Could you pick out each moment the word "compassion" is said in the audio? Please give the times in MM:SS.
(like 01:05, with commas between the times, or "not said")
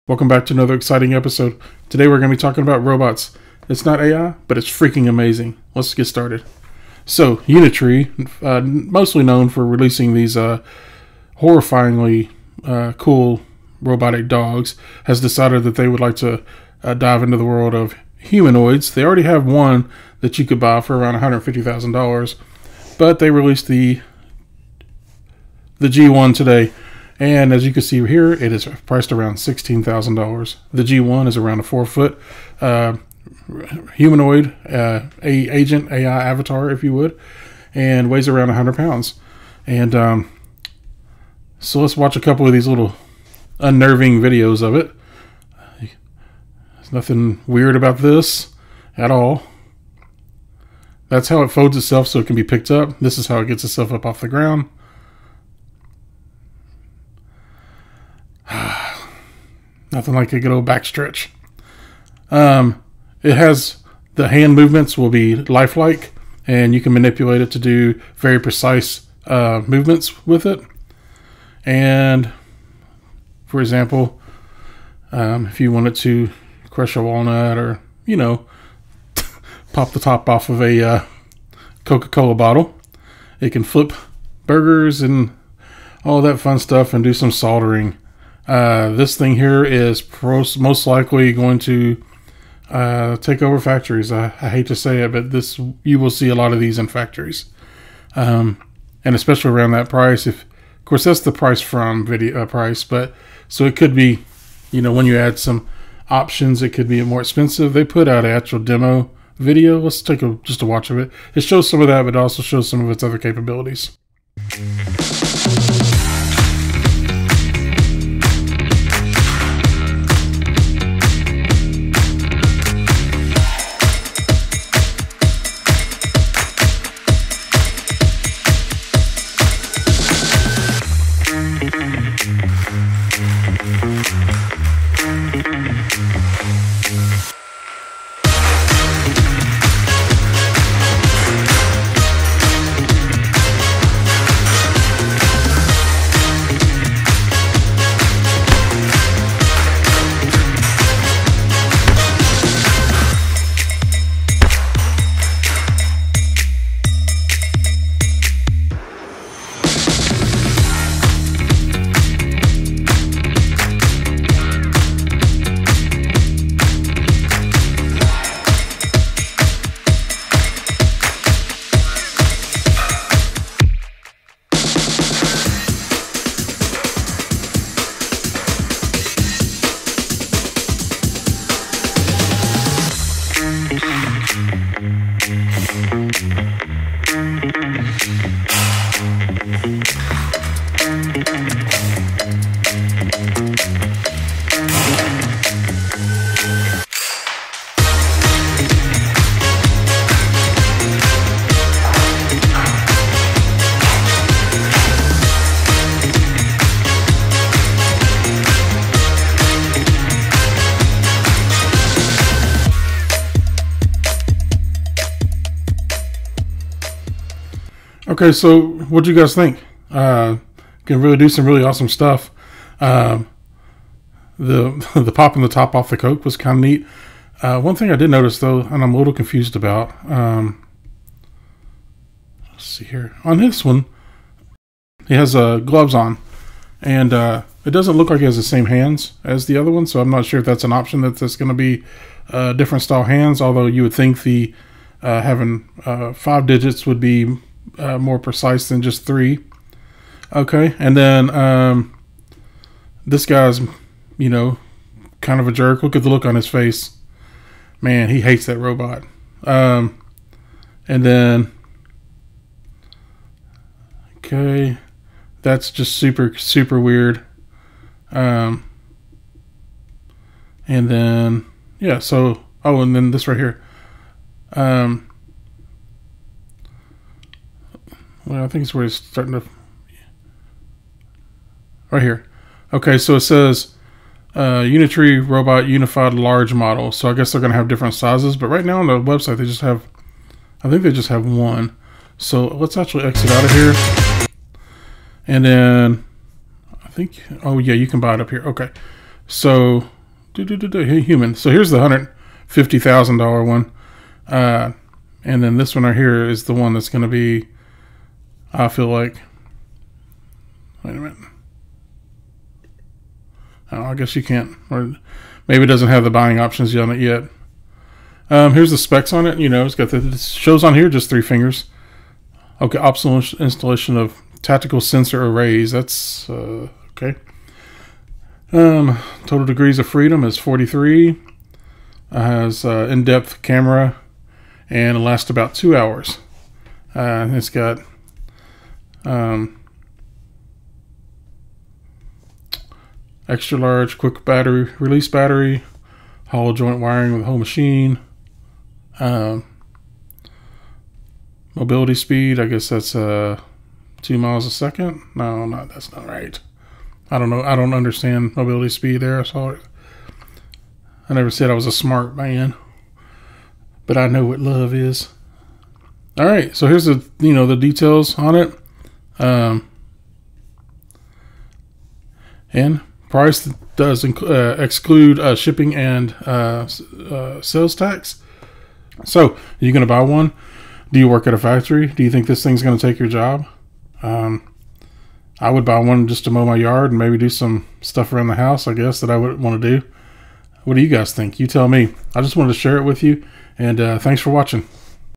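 not said.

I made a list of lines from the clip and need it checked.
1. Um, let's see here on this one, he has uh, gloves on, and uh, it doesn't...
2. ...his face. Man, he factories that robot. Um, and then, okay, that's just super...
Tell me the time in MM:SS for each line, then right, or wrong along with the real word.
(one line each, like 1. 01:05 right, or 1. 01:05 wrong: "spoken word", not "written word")
1. 03:50 right
2. 04:16 wrong: "hates", not "factories".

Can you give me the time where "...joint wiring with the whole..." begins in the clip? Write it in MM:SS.
05:46.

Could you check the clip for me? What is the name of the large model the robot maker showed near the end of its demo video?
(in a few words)
Unitree Robot Unified Large Model.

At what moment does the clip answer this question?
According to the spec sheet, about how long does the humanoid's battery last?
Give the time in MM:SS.
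05:35.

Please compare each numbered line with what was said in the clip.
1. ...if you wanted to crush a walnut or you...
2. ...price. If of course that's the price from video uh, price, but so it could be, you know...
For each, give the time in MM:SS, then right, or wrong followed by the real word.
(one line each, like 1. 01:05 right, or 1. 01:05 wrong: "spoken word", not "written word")
1. 01:15 right
2. 01:39 right.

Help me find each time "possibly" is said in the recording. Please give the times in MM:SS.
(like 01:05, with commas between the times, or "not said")
not said.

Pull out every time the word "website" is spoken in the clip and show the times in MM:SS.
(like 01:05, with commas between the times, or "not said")
04:48.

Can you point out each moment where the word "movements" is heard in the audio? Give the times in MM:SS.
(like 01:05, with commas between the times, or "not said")
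01:04, 01:09.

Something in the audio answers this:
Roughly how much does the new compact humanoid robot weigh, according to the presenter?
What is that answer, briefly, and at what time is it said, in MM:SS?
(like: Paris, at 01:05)
100 pounds, at 00:38.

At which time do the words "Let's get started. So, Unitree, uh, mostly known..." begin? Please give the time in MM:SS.
00:05.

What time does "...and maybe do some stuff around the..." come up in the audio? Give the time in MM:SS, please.
06:26.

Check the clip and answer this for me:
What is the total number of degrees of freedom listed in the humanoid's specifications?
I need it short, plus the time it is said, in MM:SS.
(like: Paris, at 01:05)
43, at 05:30.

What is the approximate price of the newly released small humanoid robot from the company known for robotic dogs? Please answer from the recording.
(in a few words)
$16,000.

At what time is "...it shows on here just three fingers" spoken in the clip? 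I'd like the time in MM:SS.
05:19.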